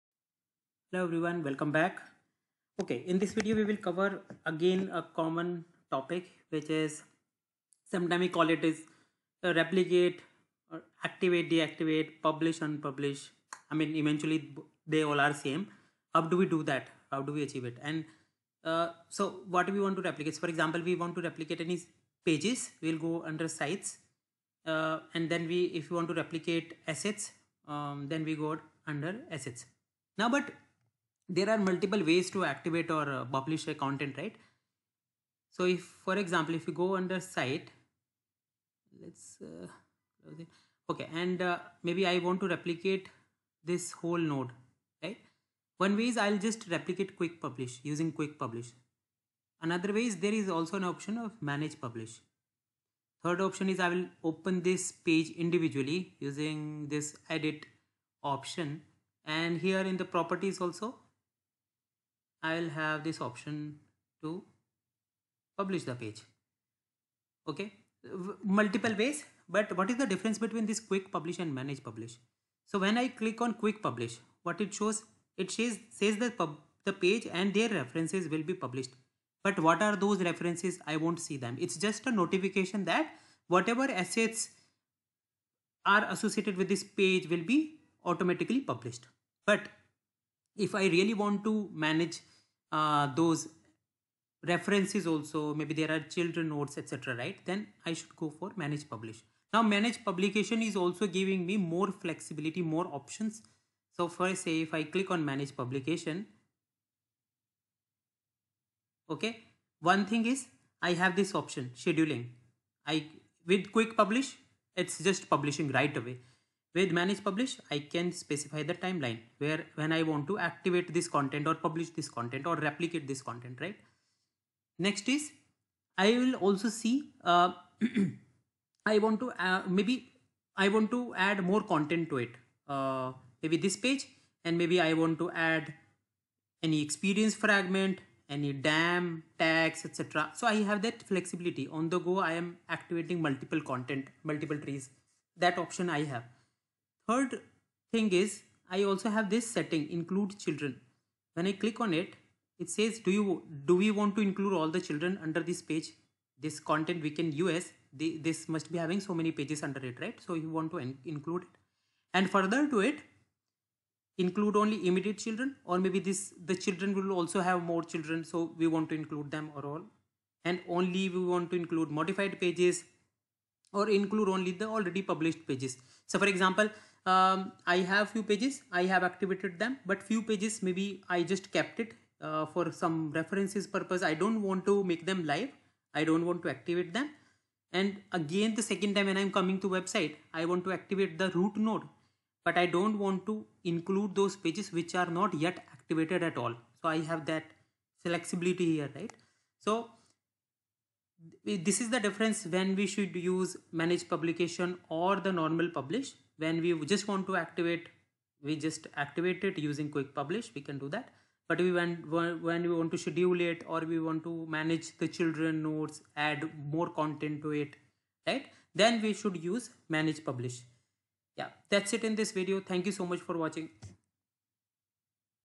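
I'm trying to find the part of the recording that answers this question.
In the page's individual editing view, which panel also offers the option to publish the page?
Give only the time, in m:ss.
1:00.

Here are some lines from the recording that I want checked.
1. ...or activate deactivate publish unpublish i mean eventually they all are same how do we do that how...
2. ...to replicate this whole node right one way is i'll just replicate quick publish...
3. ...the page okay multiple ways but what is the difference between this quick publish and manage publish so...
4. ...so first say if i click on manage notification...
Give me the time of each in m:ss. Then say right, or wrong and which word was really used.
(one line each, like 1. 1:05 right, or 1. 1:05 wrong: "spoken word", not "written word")
1. 0:10 right
2. 0:42 right
3. 1:05 right
4. 1:43 wrong: "publication", not "notification".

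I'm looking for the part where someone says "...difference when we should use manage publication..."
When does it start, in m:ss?
3:21.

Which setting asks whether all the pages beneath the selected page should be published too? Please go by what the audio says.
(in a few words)
include children.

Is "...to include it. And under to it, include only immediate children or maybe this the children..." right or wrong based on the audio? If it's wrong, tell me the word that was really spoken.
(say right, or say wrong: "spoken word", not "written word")
wrong: "further", not "under".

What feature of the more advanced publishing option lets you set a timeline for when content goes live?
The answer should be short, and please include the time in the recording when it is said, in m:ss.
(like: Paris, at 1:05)
scheduling, at 1:51.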